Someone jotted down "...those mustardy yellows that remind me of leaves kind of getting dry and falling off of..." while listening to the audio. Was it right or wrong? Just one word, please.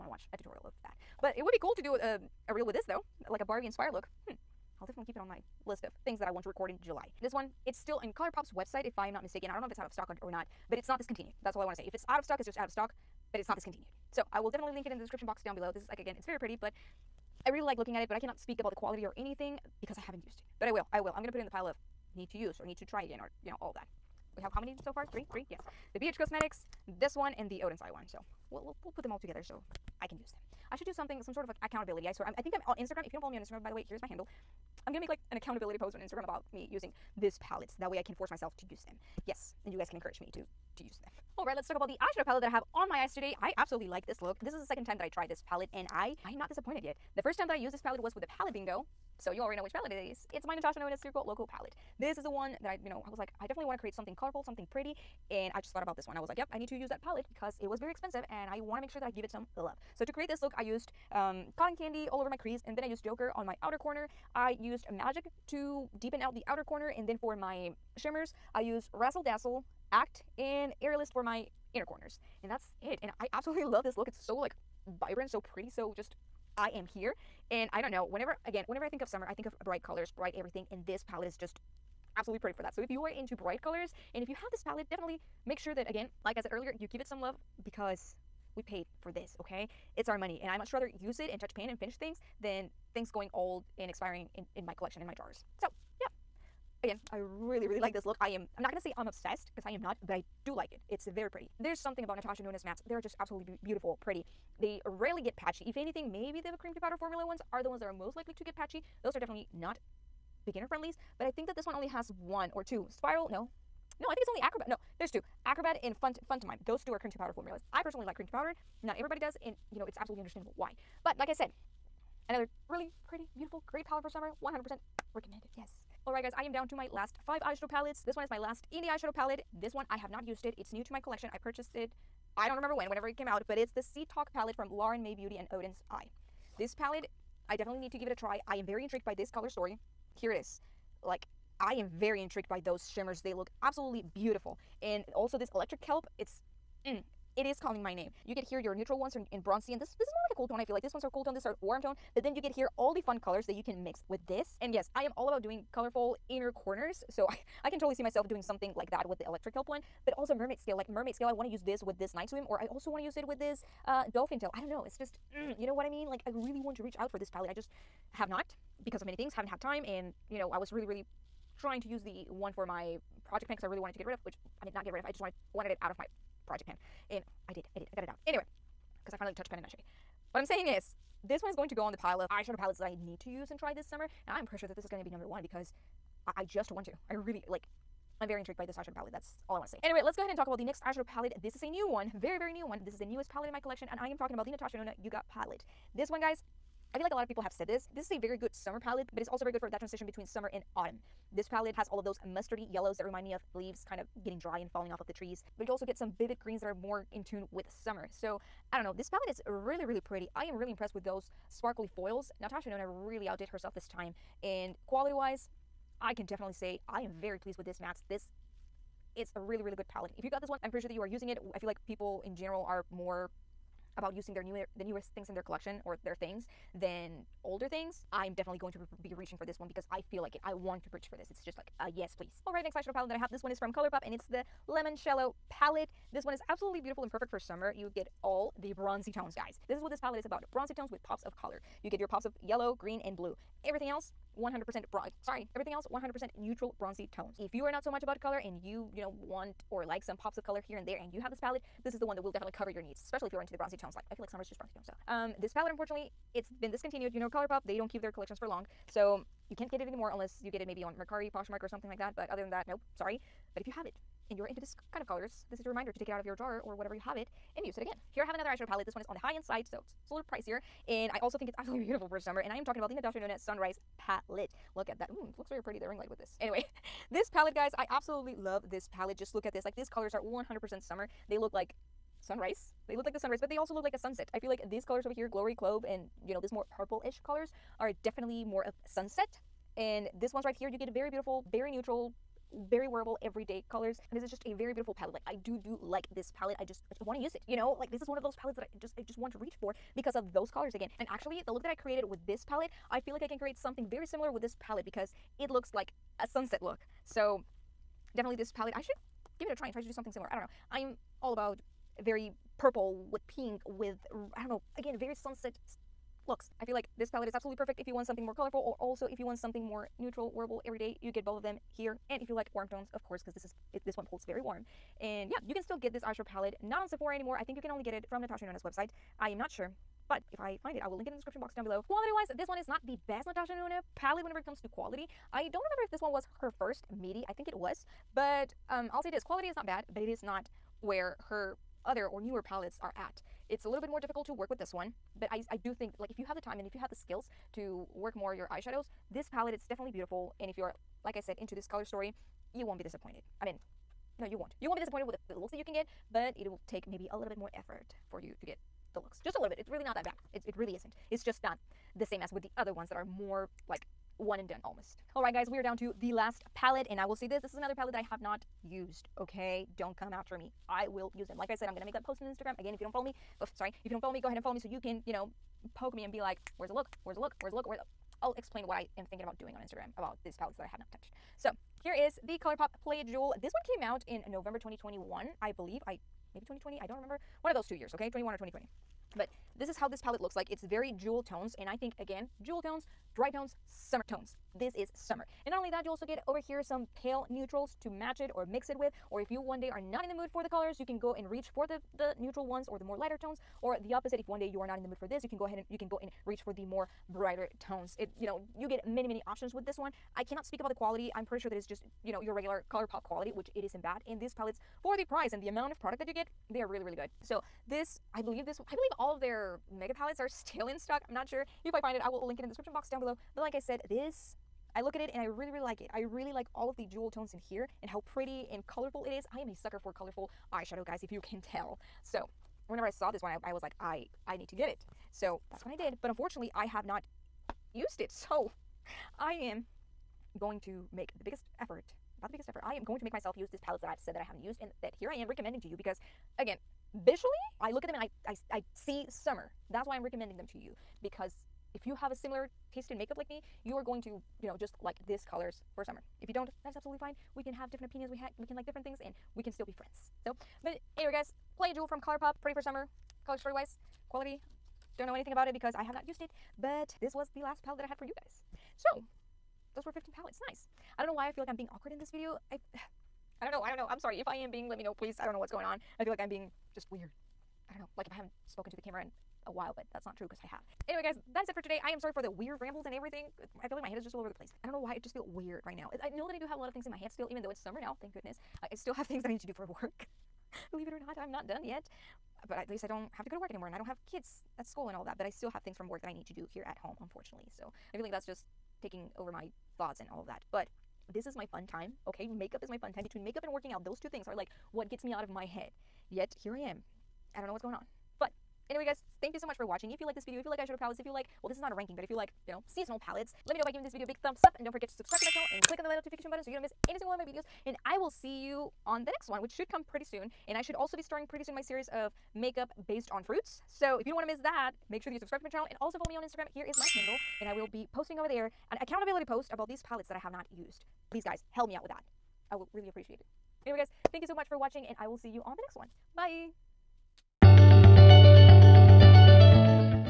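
right.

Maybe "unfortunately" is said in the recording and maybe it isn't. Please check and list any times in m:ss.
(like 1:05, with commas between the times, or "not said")
4:15, 7:16, 8:17.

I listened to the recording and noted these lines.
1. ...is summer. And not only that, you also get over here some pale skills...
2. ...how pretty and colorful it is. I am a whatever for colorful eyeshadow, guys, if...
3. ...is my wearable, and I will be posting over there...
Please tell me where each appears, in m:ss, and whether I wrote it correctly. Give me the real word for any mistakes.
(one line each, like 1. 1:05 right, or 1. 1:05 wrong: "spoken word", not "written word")
1. 6:34 wrong: "neutrals", not "skills"
2. 7:07 wrong: "sucker", not "whatever"
3. 8:46 wrong: "handle", not "wearable".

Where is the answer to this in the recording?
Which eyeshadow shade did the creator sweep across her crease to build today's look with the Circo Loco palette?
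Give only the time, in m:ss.
1:01.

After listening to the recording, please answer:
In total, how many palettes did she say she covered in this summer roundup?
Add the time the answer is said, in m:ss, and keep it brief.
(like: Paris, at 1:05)
15, at 7:49.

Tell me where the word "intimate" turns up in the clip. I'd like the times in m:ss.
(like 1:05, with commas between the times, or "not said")
not said.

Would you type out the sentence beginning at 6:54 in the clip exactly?
And these palettes, for the price and the amount of product that you get, they are really, really good.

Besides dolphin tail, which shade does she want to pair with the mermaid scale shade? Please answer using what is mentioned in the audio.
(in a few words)
Night Swim.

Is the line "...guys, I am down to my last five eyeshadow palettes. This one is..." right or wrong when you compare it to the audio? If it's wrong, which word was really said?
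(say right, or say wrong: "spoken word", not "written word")
right.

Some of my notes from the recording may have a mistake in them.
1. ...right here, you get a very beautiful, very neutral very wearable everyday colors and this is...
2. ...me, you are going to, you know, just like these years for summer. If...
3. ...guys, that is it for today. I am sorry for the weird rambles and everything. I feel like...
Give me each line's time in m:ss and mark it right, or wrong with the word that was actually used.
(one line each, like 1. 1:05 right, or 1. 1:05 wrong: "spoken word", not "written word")
1. 4:50 right
2. 7:33 wrong: "colors", not "years"
3. 8:01 right.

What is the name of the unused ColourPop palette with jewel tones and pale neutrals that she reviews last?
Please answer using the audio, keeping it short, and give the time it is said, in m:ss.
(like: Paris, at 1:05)
Play Jewel, at 6:22.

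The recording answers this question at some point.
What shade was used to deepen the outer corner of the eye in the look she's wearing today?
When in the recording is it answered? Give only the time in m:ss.
1:04.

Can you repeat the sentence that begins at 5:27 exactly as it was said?
I think you can only get it from Natasha Denona's website.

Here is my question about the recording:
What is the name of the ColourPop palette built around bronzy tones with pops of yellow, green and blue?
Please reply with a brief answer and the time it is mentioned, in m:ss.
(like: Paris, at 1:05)
Limoncello, at 3:54.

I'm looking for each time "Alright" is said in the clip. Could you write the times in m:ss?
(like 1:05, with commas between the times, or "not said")
0:41, 2:06, 6:05.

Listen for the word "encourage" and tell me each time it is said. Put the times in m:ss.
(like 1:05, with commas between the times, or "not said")
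0:39.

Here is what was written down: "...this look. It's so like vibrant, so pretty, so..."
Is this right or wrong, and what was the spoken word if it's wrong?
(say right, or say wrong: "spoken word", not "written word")
right.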